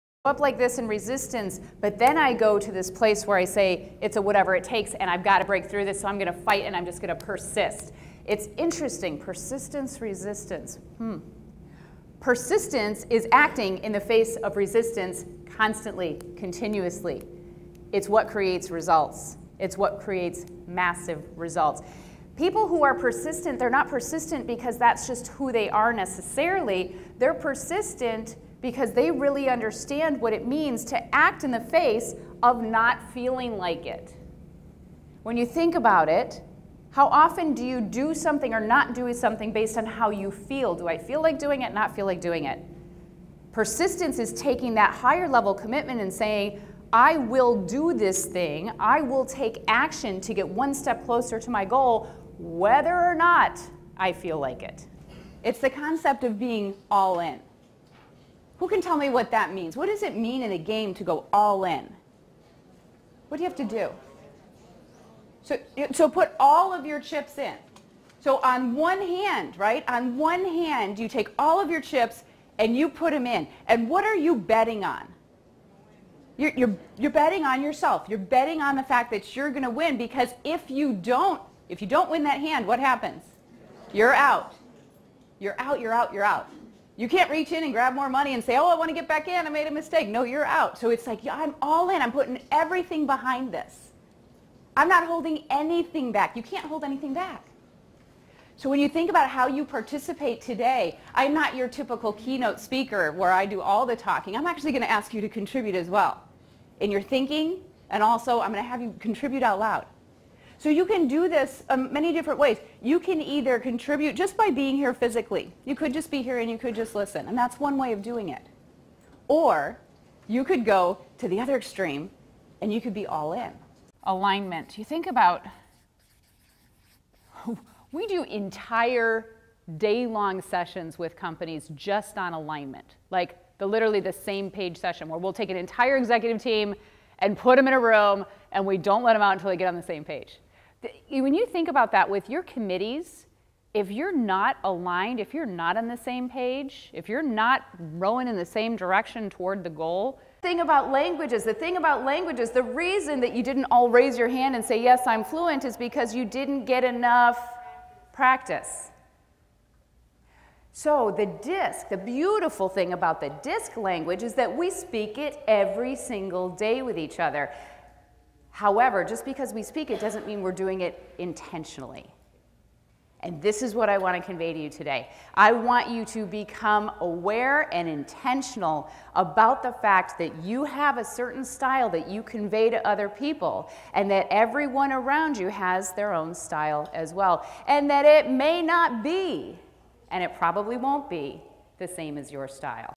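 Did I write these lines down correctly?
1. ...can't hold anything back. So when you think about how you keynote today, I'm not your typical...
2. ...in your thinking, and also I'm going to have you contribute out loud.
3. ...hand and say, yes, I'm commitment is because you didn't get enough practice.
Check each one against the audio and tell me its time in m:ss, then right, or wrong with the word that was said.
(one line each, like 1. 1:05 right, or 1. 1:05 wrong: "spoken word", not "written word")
1. 1:36 wrong: "participate", not "keynote"
2. 1:46 right
3. 2:34 wrong: "fluent", not "commitment".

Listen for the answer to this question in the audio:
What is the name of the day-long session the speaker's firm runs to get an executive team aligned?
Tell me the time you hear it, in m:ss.
2:14.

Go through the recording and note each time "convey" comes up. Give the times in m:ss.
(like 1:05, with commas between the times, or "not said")
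2:54, 3:02.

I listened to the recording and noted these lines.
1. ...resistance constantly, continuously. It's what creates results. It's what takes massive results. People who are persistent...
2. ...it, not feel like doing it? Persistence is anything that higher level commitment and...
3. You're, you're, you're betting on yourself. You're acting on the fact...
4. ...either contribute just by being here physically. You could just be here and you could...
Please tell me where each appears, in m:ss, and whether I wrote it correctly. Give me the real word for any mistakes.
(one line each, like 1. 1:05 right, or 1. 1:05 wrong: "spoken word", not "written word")
1. 0:14 wrong: "creates", not "takes"
2. 0:41 wrong: "taking", not "anything"
3. 1:16 wrong: "betting", not "acting"
4. 1:53 right.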